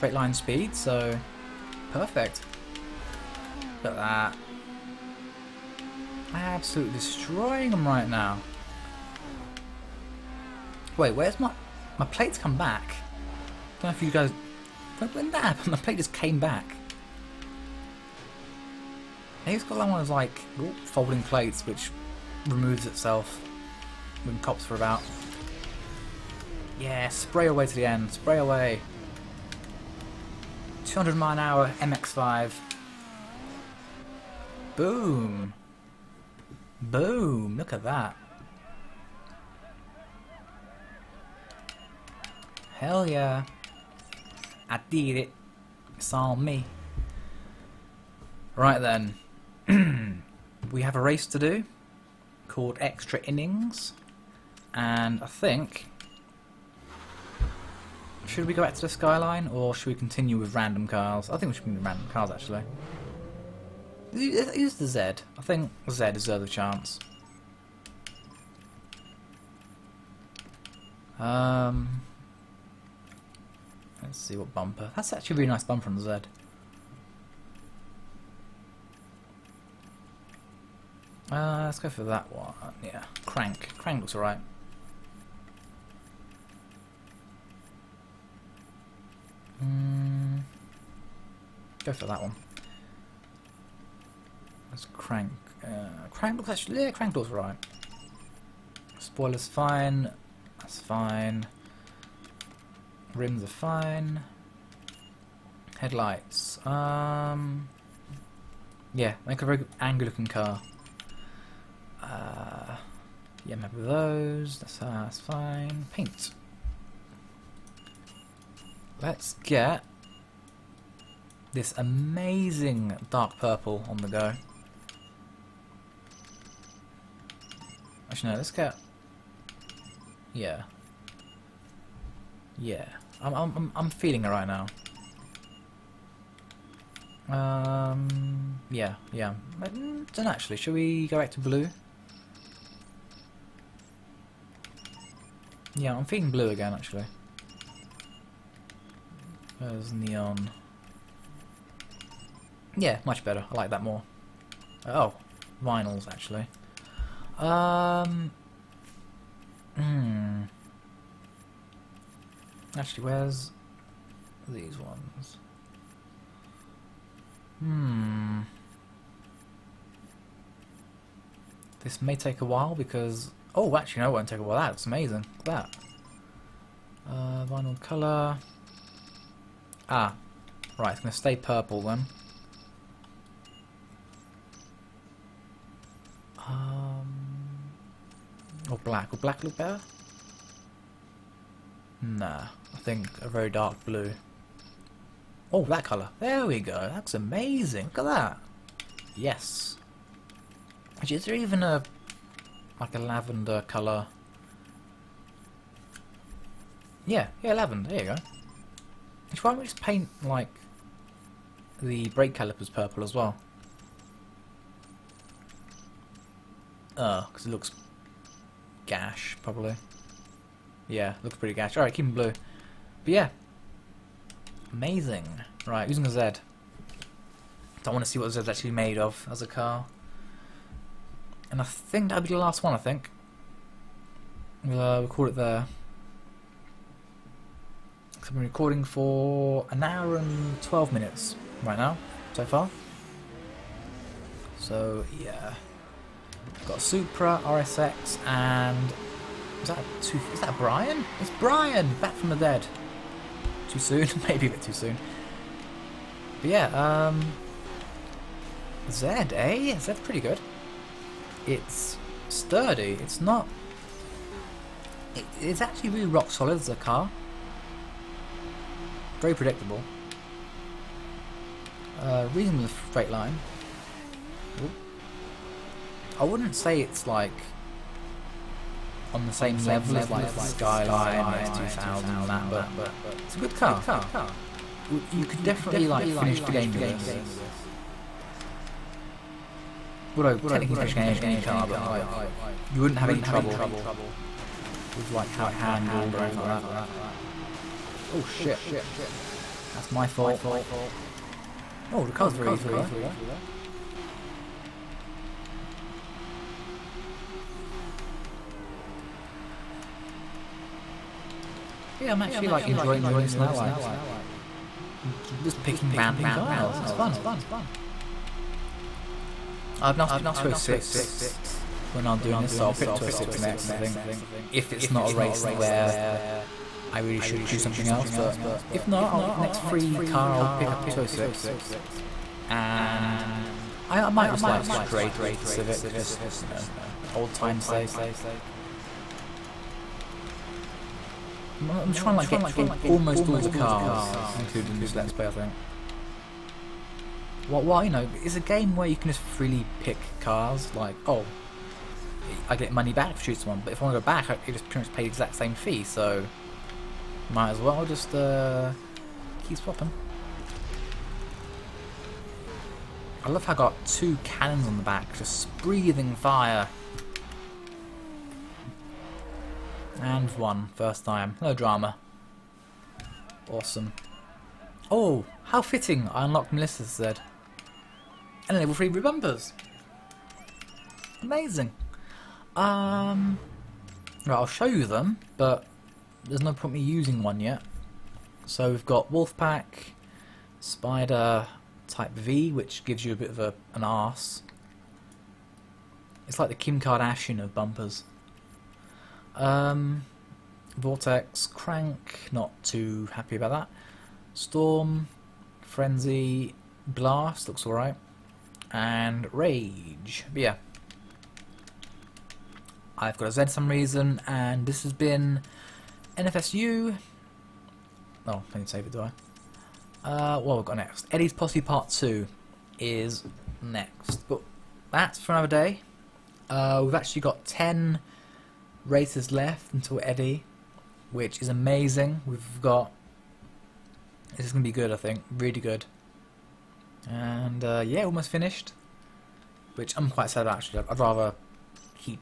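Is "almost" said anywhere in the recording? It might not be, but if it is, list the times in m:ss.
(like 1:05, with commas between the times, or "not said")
5:42, 7:18.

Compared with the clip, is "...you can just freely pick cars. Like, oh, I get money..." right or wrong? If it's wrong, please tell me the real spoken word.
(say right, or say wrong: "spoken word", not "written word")
right.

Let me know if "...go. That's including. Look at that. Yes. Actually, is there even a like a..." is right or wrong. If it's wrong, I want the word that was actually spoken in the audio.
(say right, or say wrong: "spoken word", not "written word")
wrong: "amazing", not "including".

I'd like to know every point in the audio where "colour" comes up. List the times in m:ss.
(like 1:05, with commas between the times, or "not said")
2:57, 3:15, 3:23.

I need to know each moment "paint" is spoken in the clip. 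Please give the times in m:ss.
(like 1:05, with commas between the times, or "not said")
1:55, 3:29.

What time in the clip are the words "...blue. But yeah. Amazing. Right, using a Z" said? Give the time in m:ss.
3:42.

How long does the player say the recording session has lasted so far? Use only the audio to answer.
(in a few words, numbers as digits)
1 hour 12 minutes.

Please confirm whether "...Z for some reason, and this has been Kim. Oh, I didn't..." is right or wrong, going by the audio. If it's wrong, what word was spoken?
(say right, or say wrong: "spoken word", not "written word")
wrong: "NFSU", not "Kim".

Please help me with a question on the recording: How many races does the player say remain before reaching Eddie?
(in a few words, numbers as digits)
10.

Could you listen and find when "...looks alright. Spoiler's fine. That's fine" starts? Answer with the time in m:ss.
1:37.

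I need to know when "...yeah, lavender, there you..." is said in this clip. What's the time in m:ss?
3:27.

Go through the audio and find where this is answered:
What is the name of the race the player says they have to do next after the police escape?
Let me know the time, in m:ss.
0:52.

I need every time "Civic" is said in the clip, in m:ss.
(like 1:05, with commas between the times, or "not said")
5:35.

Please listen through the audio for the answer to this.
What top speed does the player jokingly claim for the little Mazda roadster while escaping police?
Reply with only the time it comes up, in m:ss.
0:30.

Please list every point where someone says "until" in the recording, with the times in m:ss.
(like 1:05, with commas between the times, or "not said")
7:09.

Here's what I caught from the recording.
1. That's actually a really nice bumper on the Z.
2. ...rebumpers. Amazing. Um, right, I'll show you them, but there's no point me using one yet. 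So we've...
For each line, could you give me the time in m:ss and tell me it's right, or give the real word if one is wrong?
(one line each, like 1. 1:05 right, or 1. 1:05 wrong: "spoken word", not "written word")
1. 1:14 right
2. 6:18 right.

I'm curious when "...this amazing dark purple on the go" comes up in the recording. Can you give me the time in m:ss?
2:01.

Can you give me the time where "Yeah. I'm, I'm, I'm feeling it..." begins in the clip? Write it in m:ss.
2:12.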